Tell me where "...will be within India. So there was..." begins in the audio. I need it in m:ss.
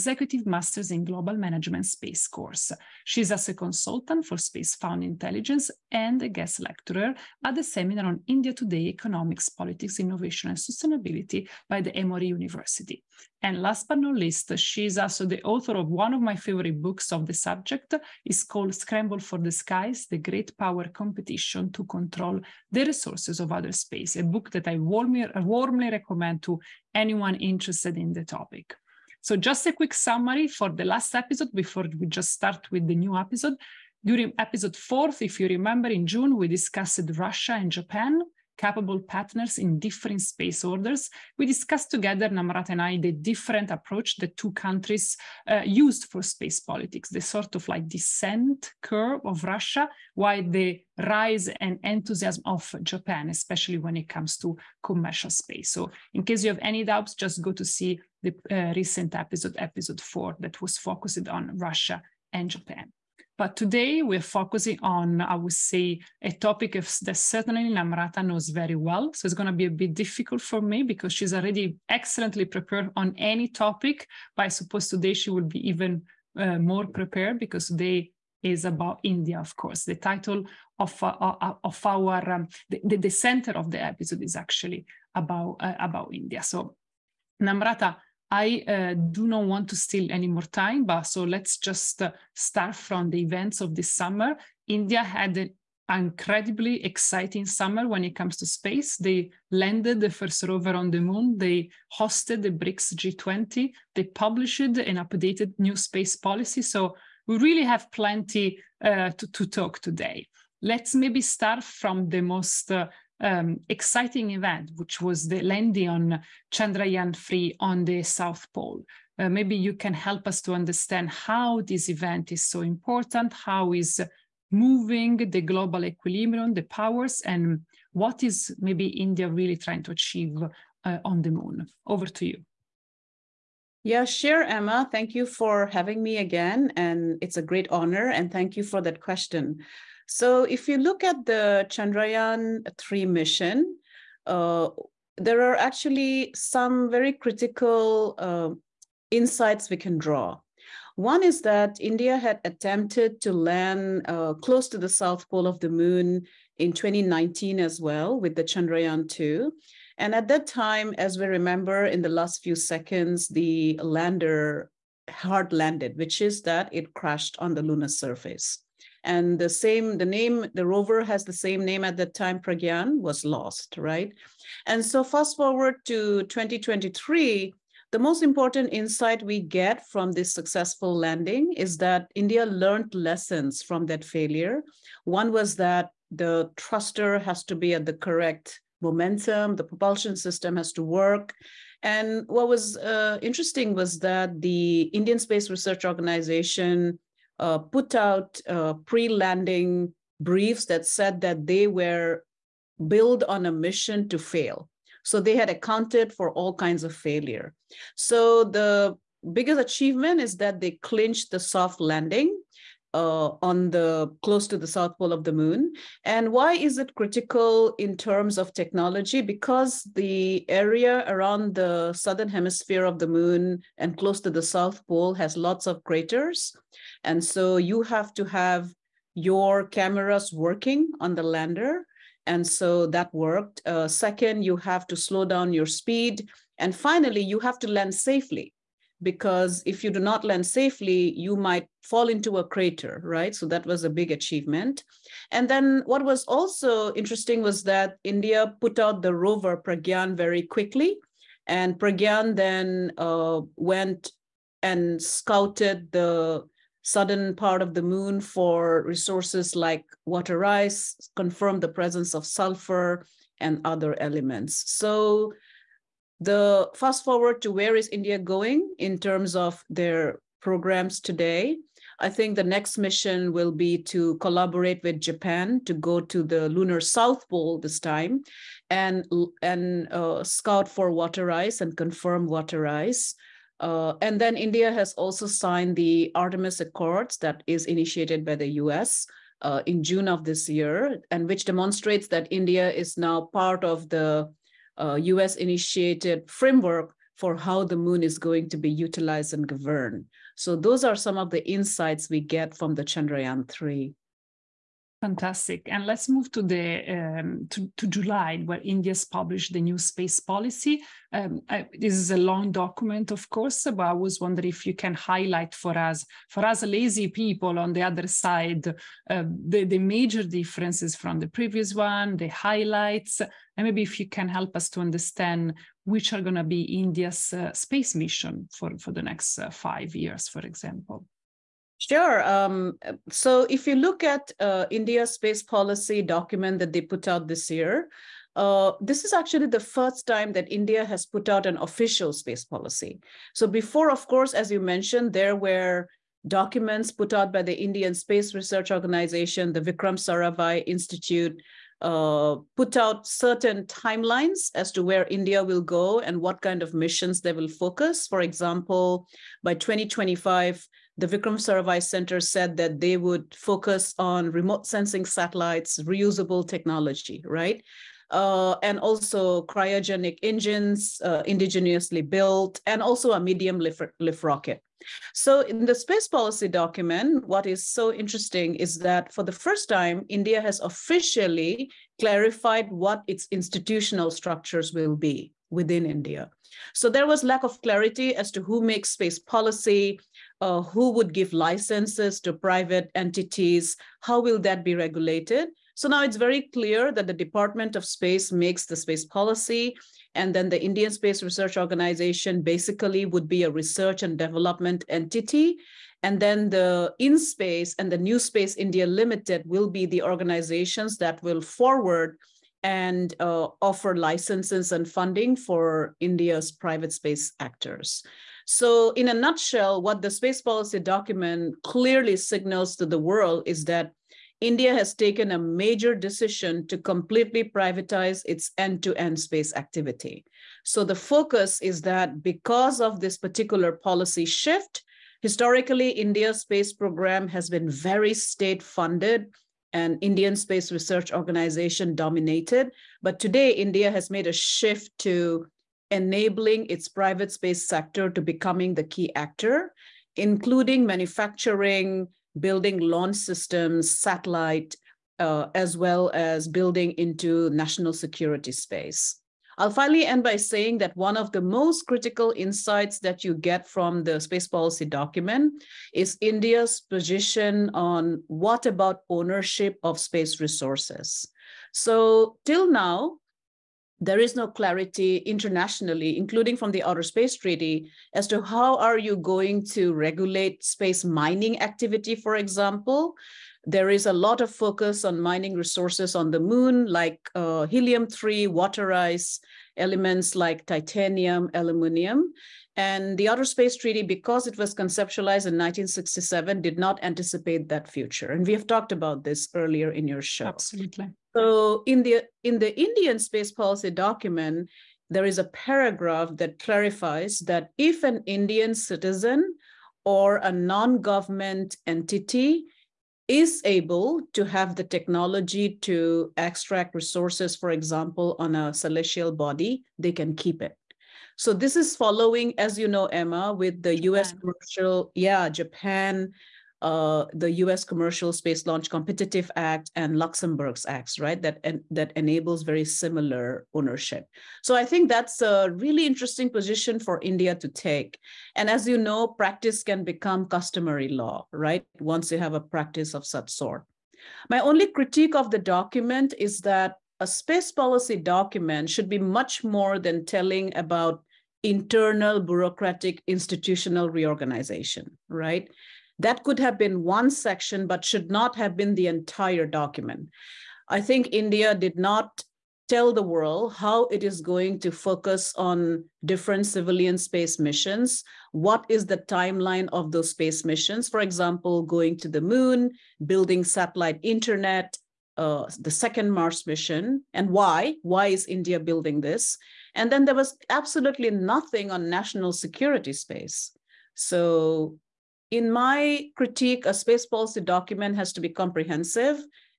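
6:24.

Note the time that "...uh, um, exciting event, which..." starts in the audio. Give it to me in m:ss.
1:52.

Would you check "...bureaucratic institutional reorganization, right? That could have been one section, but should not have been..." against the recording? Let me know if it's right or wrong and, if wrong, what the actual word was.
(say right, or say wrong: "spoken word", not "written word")
right.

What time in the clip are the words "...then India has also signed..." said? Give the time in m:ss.
4:44.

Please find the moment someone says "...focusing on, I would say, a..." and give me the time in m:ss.
1:04.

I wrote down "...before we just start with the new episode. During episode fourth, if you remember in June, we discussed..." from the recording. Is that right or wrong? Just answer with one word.
right.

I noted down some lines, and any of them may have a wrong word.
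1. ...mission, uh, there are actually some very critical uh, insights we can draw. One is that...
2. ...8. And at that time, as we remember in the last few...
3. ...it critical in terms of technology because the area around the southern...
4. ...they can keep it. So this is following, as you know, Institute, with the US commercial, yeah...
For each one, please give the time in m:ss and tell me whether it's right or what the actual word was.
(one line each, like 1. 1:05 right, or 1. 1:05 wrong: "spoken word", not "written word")
1. 2:23 right
2. 2:39 wrong: "2", not "8"
3. 3:36 right
4. 8:39 wrong: "Emma", not "Institute".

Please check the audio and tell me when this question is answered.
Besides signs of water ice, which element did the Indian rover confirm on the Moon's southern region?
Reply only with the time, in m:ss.
4:22.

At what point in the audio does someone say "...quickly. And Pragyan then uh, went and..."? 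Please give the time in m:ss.
4:10.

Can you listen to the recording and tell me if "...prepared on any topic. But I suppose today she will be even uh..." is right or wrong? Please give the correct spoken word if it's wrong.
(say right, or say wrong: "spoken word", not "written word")
right.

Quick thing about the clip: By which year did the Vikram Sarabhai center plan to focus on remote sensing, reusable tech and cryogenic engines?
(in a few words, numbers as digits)
2025.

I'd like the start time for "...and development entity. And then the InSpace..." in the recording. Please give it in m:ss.
6:44.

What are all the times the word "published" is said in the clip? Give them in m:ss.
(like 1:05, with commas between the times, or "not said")
1:44, 5:09.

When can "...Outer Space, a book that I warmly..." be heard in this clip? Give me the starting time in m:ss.
0:23.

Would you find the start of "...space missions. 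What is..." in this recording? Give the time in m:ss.
9:27.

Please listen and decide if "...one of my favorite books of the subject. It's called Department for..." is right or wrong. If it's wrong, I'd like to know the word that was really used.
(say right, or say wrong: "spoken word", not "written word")
wrong: "Scramble", not "Department".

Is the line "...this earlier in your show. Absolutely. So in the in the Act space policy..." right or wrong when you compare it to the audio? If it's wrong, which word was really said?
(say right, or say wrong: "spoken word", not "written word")
wrong: "Indian", not "Act".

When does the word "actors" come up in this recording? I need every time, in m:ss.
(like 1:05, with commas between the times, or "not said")
6:57, 7:29.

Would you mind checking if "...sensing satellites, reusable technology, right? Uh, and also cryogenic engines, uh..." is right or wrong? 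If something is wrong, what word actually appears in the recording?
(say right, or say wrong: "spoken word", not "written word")
right.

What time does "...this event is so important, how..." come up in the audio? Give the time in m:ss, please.
2:01.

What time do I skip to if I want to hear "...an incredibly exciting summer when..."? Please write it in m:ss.
1:35.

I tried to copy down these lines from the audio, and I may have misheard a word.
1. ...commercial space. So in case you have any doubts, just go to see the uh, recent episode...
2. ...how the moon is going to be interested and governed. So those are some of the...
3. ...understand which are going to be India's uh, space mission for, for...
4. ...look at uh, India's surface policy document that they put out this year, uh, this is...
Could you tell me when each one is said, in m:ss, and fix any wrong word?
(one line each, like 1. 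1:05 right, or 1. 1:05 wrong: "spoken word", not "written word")
1. 0:54 right
2. 4:57 wrong: "utilized", not "interested"
3. 5:24 right
4. 5:33 wrong: "space", not "surface".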